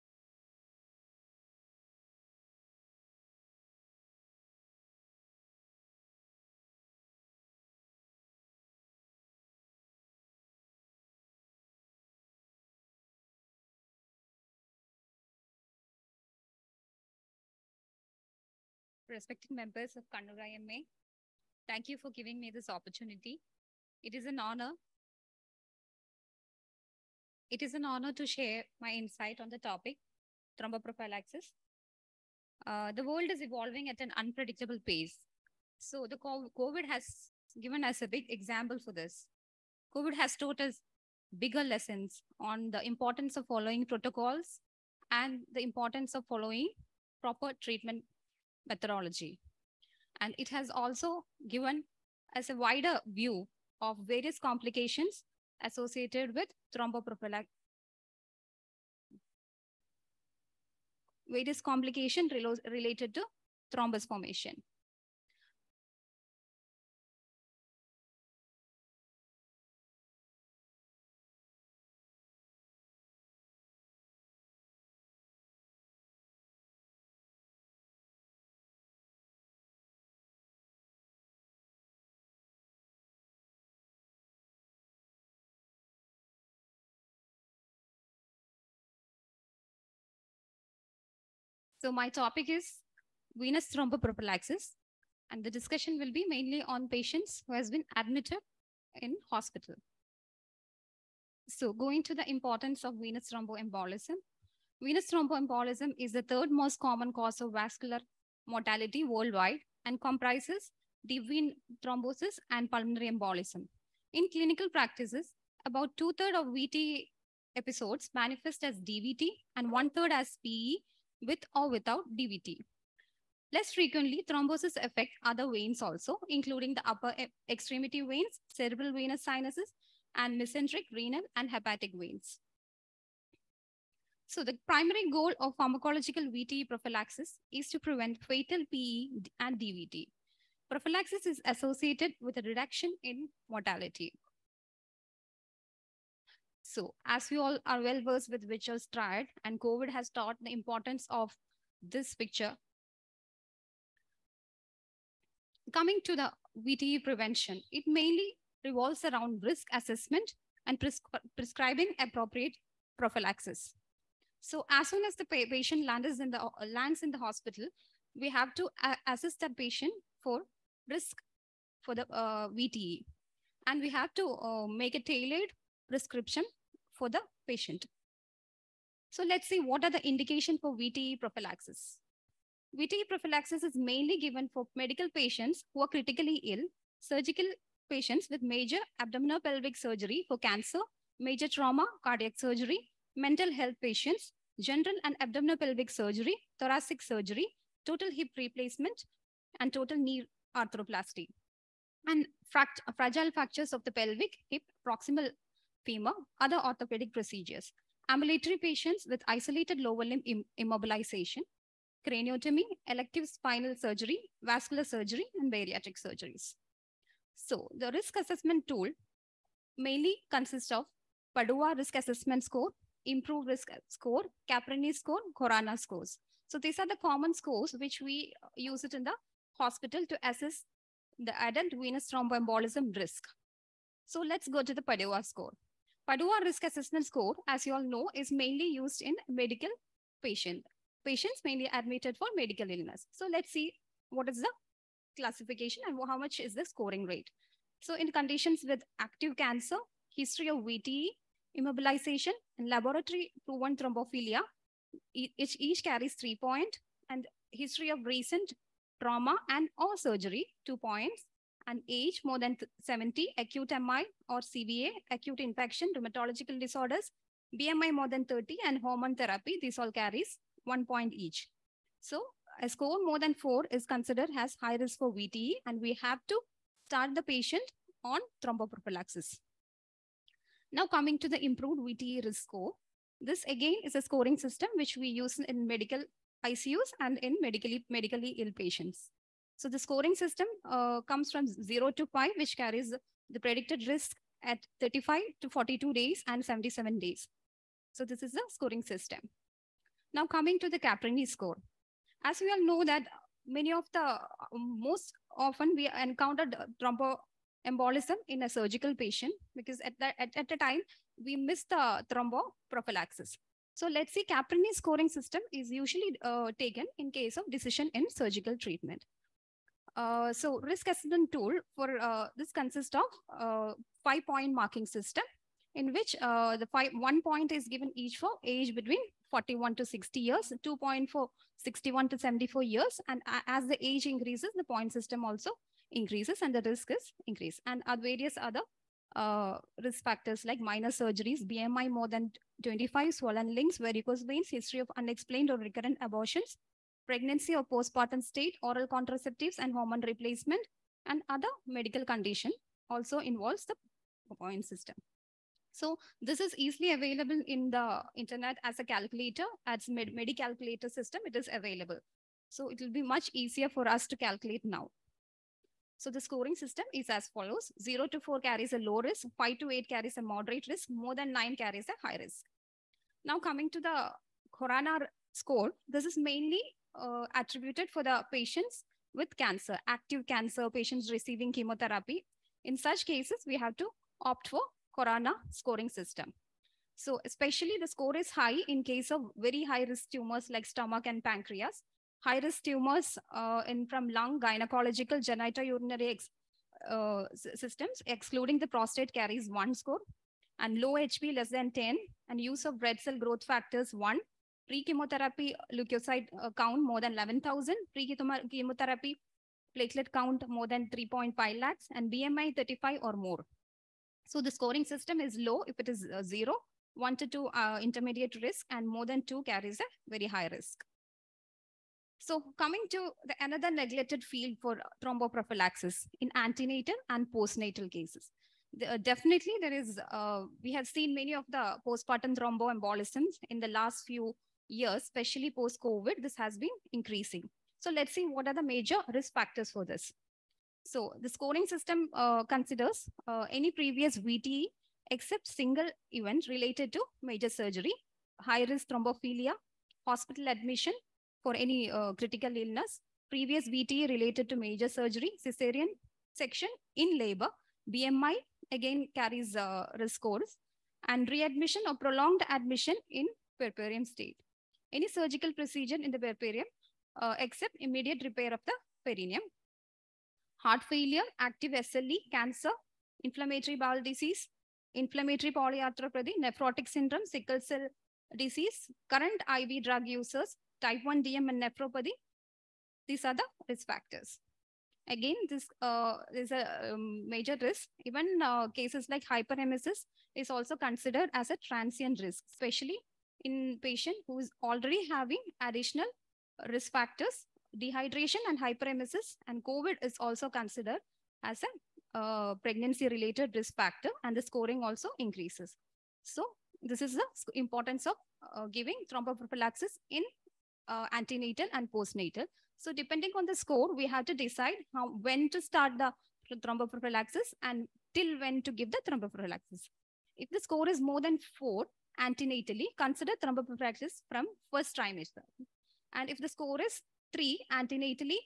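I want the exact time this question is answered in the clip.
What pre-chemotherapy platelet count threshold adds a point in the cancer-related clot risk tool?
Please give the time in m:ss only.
6:50.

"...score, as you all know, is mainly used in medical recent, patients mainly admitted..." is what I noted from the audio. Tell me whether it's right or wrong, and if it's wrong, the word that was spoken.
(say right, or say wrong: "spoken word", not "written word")
wrong: "patient", not "recent".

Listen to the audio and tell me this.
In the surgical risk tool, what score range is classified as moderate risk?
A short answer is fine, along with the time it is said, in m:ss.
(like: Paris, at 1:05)
5 to 8, at 6:09.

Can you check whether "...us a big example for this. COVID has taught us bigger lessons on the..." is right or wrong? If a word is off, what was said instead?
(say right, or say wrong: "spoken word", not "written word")
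right.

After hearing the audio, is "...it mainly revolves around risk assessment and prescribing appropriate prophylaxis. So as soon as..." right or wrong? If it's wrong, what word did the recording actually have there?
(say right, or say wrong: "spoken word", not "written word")
right.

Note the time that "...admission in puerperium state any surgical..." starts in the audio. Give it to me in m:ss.
7:42.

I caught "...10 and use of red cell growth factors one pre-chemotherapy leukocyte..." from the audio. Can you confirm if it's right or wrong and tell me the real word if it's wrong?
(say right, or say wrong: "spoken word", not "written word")
right.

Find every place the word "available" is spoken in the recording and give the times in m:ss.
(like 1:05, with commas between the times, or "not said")
5:56, 6:01.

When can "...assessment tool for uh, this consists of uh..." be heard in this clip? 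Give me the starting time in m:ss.
5:20.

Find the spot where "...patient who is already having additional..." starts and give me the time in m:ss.
8:13.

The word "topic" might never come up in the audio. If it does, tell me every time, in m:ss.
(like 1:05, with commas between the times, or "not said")
0:29, 1:32.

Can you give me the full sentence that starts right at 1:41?
So going to the importance of venous thromboembolism.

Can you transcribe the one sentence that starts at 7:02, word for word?
So coming to the another neglected field for thromboprophylaxis in antenatal and postnatal cases.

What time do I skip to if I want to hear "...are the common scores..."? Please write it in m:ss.
3:46.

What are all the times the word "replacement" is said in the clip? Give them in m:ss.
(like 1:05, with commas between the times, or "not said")
3:18, 5:50.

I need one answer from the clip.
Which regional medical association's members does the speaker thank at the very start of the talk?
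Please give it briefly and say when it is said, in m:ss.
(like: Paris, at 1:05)
Kannur IMA, at 0:20.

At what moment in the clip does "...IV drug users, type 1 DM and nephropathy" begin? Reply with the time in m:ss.
7:59.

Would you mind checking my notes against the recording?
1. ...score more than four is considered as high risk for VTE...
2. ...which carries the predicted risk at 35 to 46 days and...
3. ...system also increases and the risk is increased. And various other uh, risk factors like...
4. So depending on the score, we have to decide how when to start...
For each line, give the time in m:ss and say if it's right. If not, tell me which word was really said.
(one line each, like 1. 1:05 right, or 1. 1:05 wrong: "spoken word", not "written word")
1. 4:32 right
2. 4:52 wrong: "42", not "46"
3. 5:34 right
4. 8:32 right.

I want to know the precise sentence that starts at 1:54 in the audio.
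In clinical practices, about two-thirds of VT episodes manifest as DVT and one-third as PE with or without DVT.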